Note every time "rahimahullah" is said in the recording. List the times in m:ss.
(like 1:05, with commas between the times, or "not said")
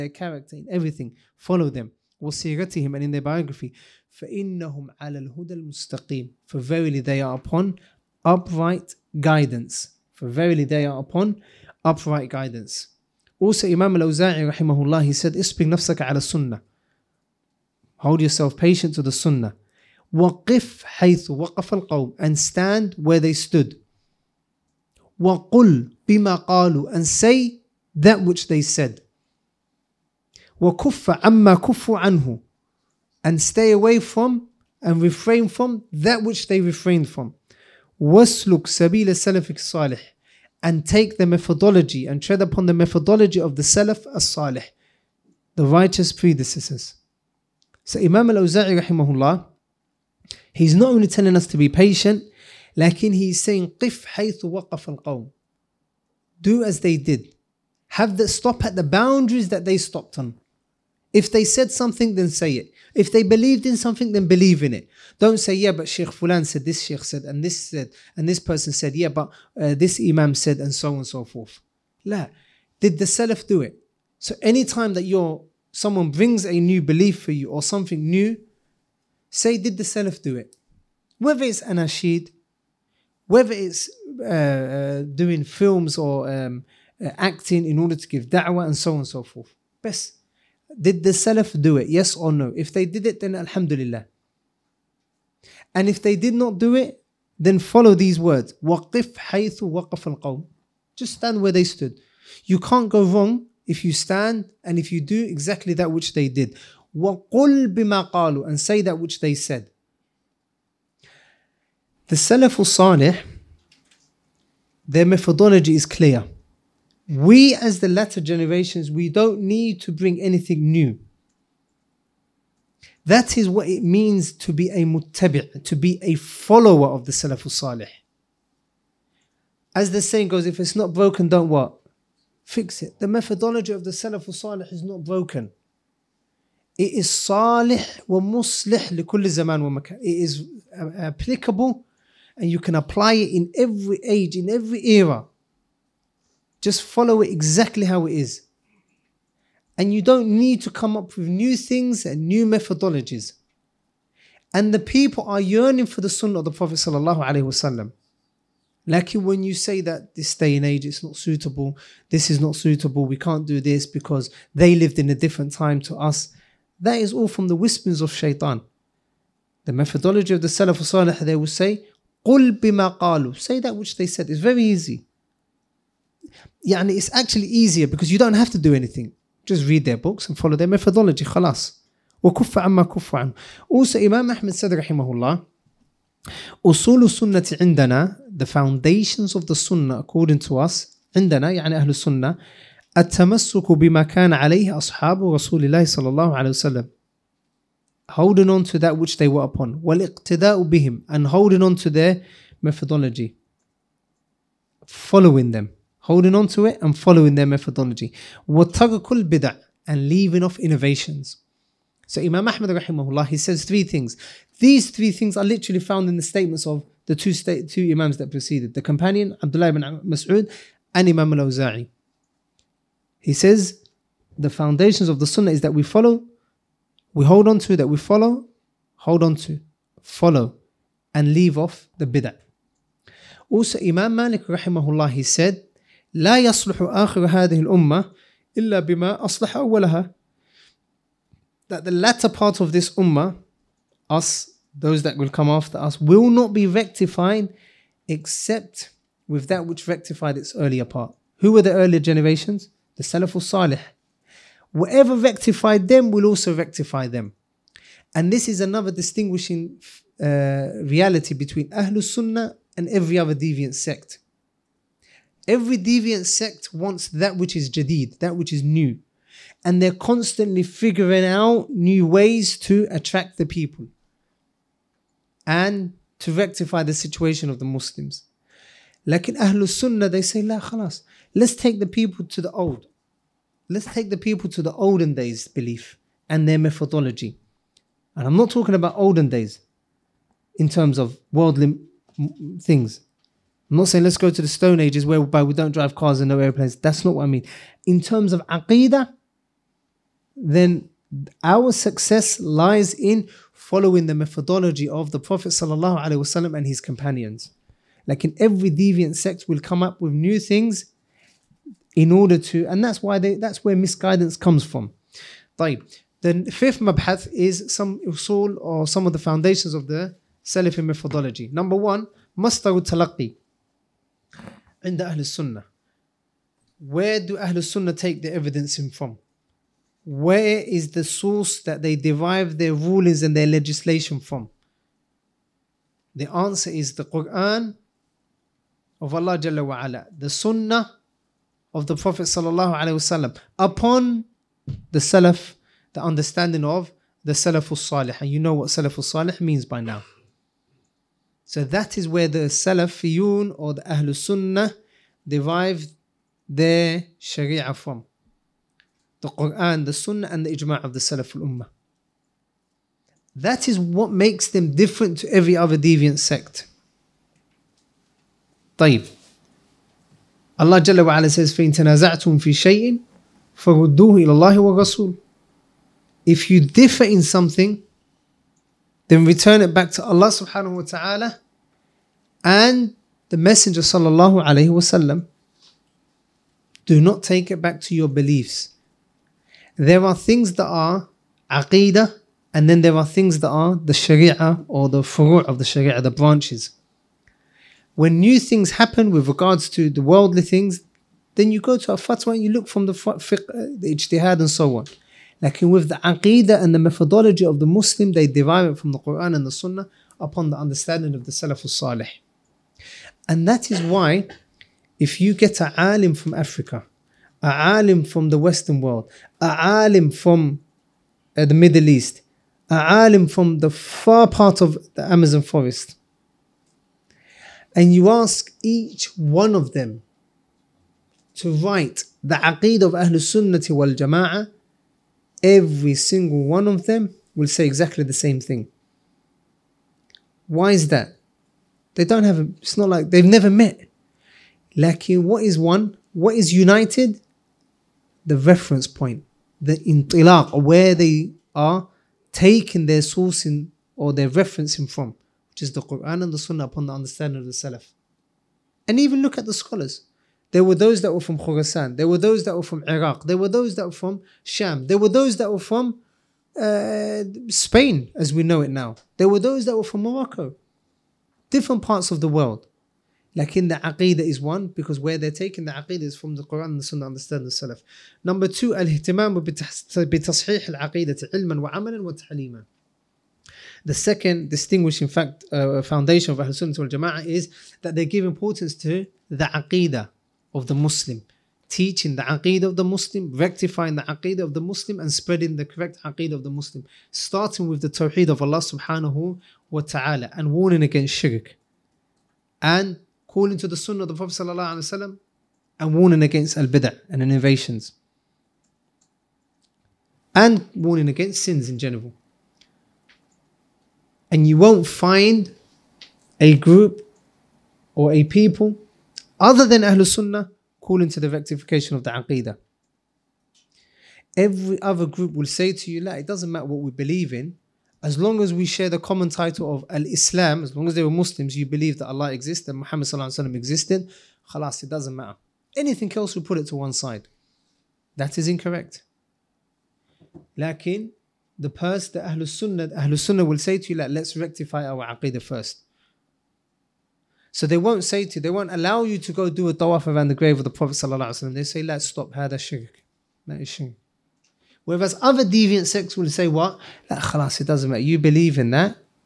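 0:14, 0:48, 3:32, 3:54.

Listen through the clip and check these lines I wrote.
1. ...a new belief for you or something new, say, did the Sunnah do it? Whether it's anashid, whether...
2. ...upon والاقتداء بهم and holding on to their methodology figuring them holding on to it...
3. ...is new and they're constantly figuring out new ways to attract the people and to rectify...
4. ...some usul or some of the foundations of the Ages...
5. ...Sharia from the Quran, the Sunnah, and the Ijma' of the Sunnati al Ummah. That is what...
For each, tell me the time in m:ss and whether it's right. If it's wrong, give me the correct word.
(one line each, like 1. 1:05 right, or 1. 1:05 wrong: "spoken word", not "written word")
1. 1:16 wrong: "Salaf", not "Sunnah"
2. 3:19 wrong: "following", not "figuring"
3. 4:28 right
4. 5:17 wrong: "Salafi", not "Ages"
5. 5:57 wrong: "Salaf", not "Sunnati".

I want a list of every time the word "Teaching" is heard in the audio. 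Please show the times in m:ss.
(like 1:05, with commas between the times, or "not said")
8:11.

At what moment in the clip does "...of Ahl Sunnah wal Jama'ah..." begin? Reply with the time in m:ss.
8:06.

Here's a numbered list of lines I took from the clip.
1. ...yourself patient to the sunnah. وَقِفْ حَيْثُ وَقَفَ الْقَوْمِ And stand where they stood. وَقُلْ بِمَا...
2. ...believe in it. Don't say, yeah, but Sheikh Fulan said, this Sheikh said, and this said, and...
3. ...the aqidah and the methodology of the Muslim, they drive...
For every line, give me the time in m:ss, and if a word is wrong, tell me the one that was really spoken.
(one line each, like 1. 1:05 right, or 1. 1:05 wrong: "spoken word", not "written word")
1. 0:18 right
2. 1:04 right
3. 6:45 wrong: "derive", not "drive".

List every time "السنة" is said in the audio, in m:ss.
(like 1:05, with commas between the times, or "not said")
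0:16, 3:07, 3:11, 5:25.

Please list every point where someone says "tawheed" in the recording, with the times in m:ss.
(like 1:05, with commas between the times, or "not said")
8:17.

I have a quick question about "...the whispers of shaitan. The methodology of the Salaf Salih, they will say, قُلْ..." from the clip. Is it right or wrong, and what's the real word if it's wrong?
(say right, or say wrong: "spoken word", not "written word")
right.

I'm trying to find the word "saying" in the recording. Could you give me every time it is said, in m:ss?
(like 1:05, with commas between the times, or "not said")
0:53, 2:10, 4:53.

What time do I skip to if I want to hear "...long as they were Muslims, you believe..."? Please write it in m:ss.
8:50.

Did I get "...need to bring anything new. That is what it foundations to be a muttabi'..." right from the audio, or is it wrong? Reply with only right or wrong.
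wrong.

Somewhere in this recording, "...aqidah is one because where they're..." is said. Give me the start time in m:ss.
7:53.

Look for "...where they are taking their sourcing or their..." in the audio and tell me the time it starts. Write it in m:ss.
7:30.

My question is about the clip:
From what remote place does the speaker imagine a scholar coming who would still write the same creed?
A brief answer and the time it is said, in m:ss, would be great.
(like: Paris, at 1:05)
the Amazon forest, at 7:05.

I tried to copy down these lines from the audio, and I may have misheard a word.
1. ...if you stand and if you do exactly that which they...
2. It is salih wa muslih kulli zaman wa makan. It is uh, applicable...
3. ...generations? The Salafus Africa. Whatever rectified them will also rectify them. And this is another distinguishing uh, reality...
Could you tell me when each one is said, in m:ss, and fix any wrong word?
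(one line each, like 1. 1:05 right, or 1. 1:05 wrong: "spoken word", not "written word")
1. 1:43 right
2. 2:16 right
3. 4:11 wrong: "Salih", not "Africa".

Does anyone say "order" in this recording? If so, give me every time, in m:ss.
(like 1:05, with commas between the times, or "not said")
1:27, 5:12.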